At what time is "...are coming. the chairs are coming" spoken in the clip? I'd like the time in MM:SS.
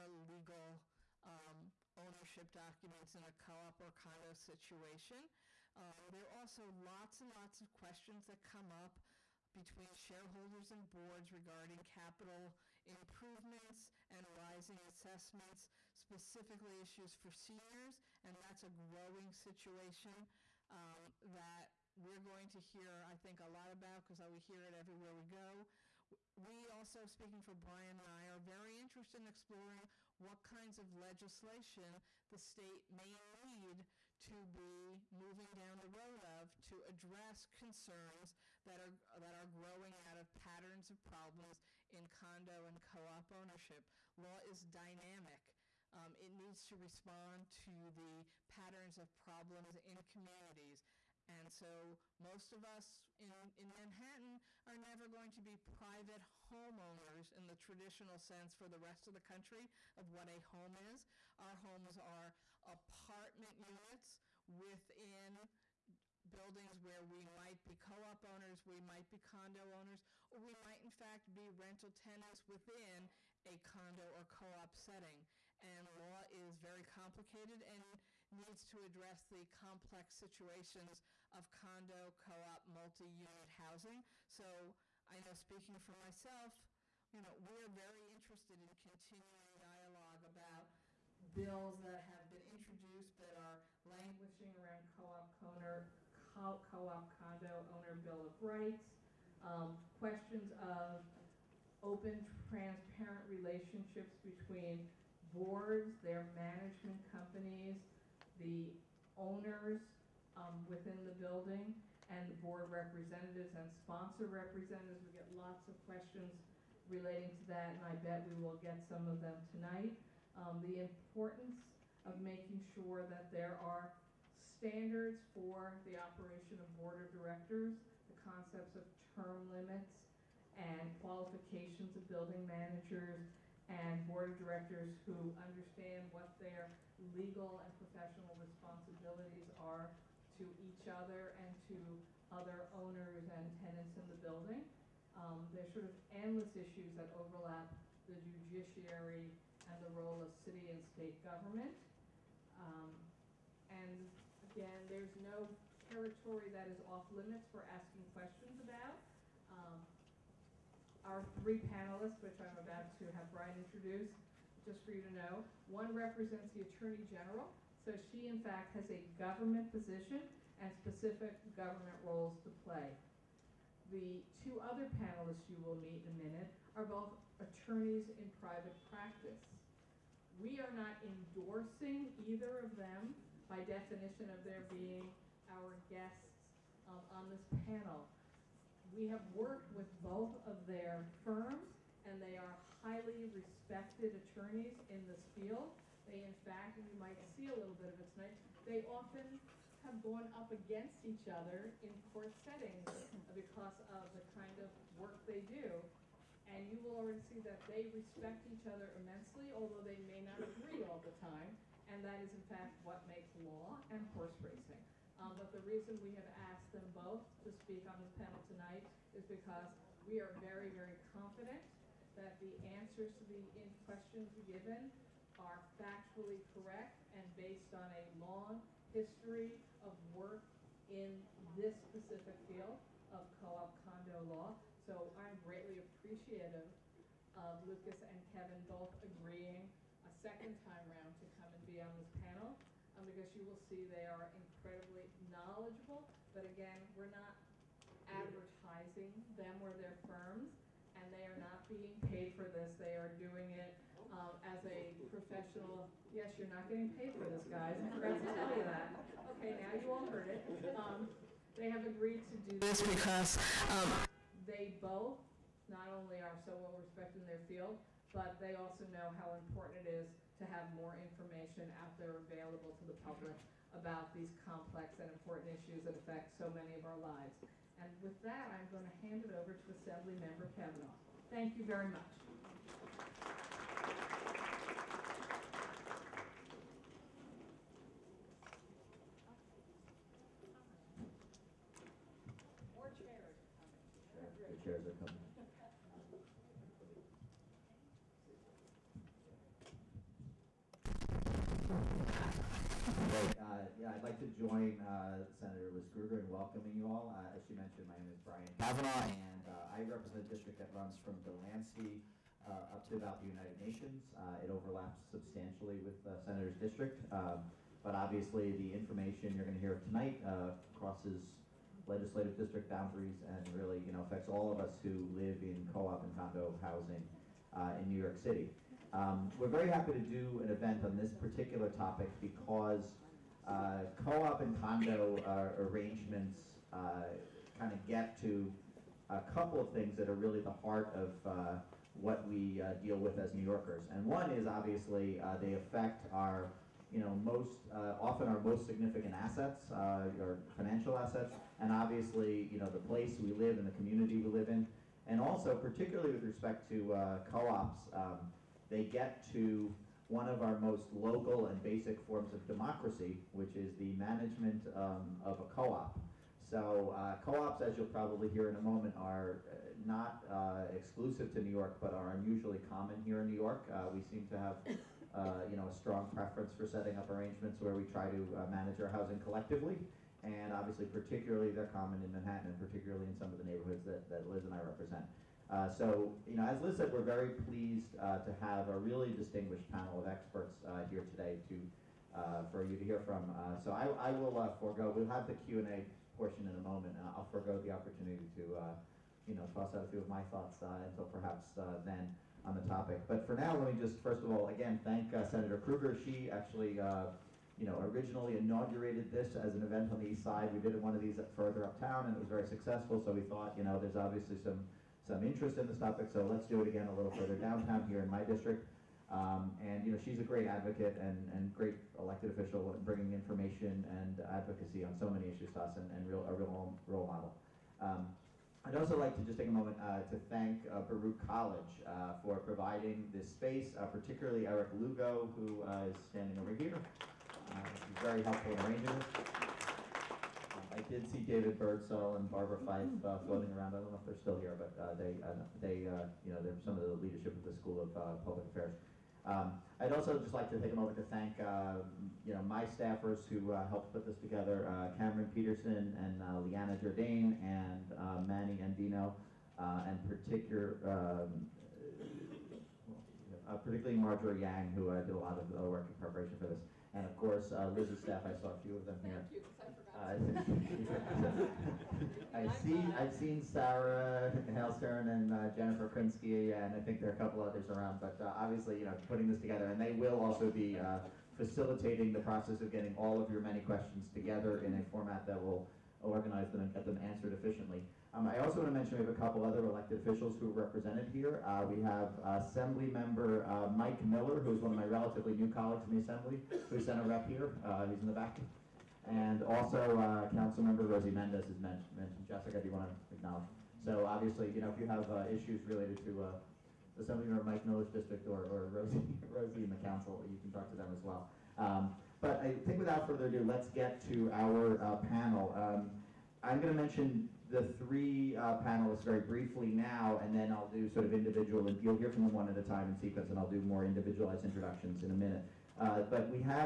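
04:53.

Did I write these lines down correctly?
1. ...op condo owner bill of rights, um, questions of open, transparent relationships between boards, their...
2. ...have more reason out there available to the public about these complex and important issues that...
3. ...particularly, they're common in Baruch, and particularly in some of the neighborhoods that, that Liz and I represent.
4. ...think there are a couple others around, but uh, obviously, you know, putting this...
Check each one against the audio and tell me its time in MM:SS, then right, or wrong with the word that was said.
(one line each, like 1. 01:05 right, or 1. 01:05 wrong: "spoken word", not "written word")
1. 01:36 right
2. 04:30 wrong: "information", not "reason"
3. 06:20 wrong: "Manhattan", not "Baruch"
4. 07:56 right.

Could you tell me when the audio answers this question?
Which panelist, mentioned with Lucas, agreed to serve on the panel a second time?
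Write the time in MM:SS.
03:58.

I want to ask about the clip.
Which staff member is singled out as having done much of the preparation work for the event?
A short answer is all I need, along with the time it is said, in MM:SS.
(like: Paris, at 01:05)
Marjorie Yang, at 07:43.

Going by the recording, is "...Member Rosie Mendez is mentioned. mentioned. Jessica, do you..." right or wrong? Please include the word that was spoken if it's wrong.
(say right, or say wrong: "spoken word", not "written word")
right.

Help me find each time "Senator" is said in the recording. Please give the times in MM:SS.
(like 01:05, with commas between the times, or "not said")
05:05, 05:16, 06:45.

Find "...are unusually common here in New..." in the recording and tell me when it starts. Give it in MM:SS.
06:11.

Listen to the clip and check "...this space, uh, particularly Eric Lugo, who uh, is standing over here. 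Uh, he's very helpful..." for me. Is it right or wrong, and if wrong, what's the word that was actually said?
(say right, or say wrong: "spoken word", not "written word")
right.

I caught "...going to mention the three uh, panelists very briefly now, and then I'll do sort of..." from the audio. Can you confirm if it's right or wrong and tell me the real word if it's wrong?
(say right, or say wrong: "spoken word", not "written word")
right.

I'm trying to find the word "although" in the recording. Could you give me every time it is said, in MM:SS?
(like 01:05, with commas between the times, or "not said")
03:29.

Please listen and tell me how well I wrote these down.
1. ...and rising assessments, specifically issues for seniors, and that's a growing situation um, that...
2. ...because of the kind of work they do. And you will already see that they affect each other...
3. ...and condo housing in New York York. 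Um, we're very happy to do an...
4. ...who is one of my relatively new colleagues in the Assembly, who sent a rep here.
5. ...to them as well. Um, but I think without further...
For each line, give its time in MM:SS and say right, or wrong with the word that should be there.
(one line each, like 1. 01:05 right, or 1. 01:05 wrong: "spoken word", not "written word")
1. 00:14 right
2. 03:23 wrong: "respect", not "affect"
3. 05:26 wrong: "City", not "York"
4. 08:14 right
5. 08:30 right.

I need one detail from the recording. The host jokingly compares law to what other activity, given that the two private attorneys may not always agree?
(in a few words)
horse racing.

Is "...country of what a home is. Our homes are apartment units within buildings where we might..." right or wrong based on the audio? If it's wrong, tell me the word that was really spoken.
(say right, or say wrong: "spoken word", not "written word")
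right.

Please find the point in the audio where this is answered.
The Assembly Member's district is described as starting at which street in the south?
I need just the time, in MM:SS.
05:11.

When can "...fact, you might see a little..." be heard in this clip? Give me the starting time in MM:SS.
03:16.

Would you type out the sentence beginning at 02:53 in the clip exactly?
The two other panelists you will meet in a minute are both attorneys in private practice.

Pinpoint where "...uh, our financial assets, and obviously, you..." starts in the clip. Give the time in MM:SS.
05:49.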